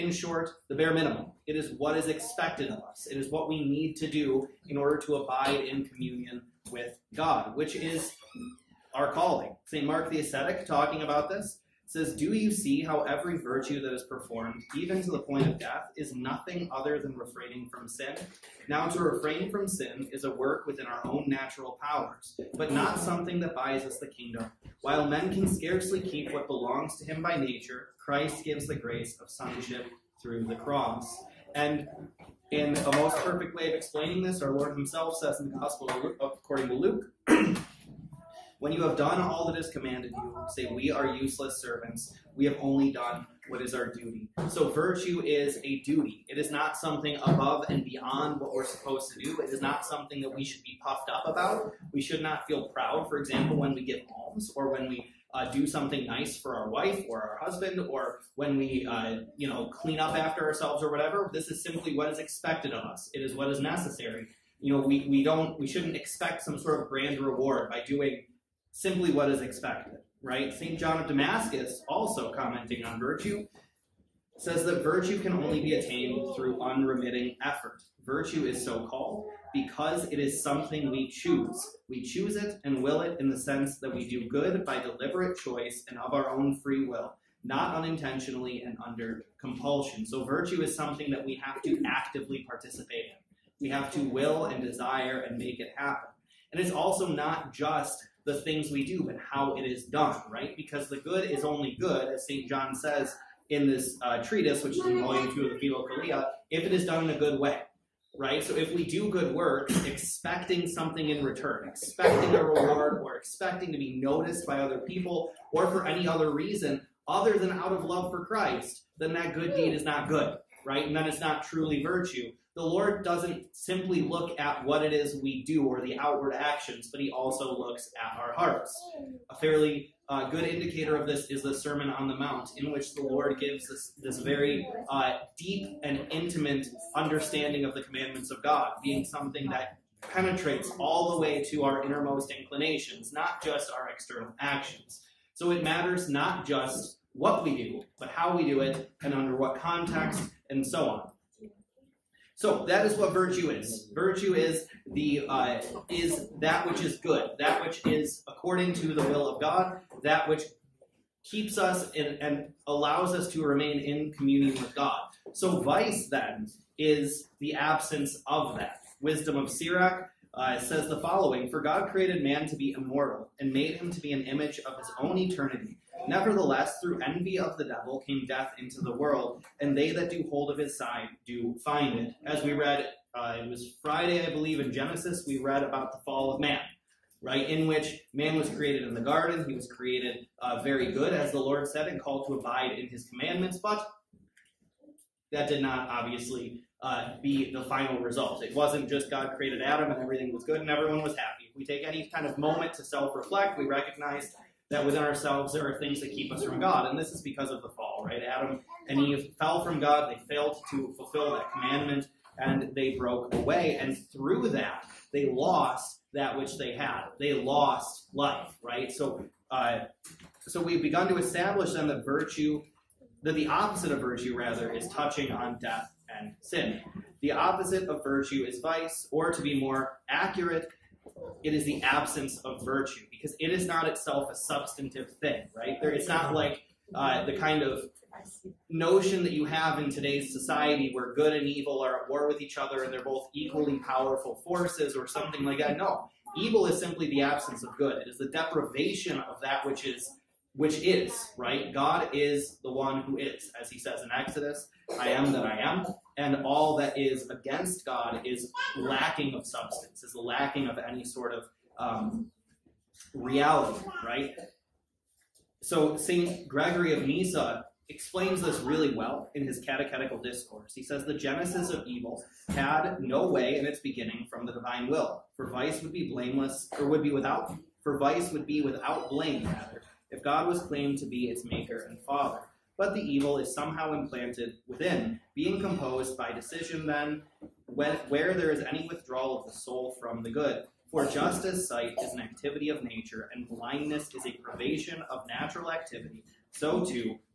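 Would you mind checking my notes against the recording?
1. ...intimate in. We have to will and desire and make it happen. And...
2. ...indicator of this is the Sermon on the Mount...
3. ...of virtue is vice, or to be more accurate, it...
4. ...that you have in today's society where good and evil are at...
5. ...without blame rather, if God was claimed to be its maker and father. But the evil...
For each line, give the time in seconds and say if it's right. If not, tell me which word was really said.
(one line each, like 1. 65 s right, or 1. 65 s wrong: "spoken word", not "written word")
1. 92 s wrong: "participate", not "intimate"
2. 130 s right
3. 227 s right
4. 239 s right
5. 278 s right.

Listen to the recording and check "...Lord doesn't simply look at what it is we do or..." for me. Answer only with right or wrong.
right.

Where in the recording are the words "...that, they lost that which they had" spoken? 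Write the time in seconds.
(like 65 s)
214 s.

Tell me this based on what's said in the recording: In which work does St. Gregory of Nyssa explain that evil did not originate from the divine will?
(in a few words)
Catechetical Discourse.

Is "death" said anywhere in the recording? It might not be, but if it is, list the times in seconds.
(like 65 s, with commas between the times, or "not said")
15 s, 178 s, 225 s.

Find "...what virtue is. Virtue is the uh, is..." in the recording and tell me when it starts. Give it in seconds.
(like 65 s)
152 s.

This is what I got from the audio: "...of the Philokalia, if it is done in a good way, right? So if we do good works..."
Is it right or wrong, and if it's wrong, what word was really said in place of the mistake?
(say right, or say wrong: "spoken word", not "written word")
right.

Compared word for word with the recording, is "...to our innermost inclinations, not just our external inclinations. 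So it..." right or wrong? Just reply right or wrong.
wrong.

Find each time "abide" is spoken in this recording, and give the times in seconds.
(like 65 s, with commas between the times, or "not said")
5 s, 192 s.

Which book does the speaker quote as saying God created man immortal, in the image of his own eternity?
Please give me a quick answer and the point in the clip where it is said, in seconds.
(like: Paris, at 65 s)
Wisdom of Sirach, at 169 s.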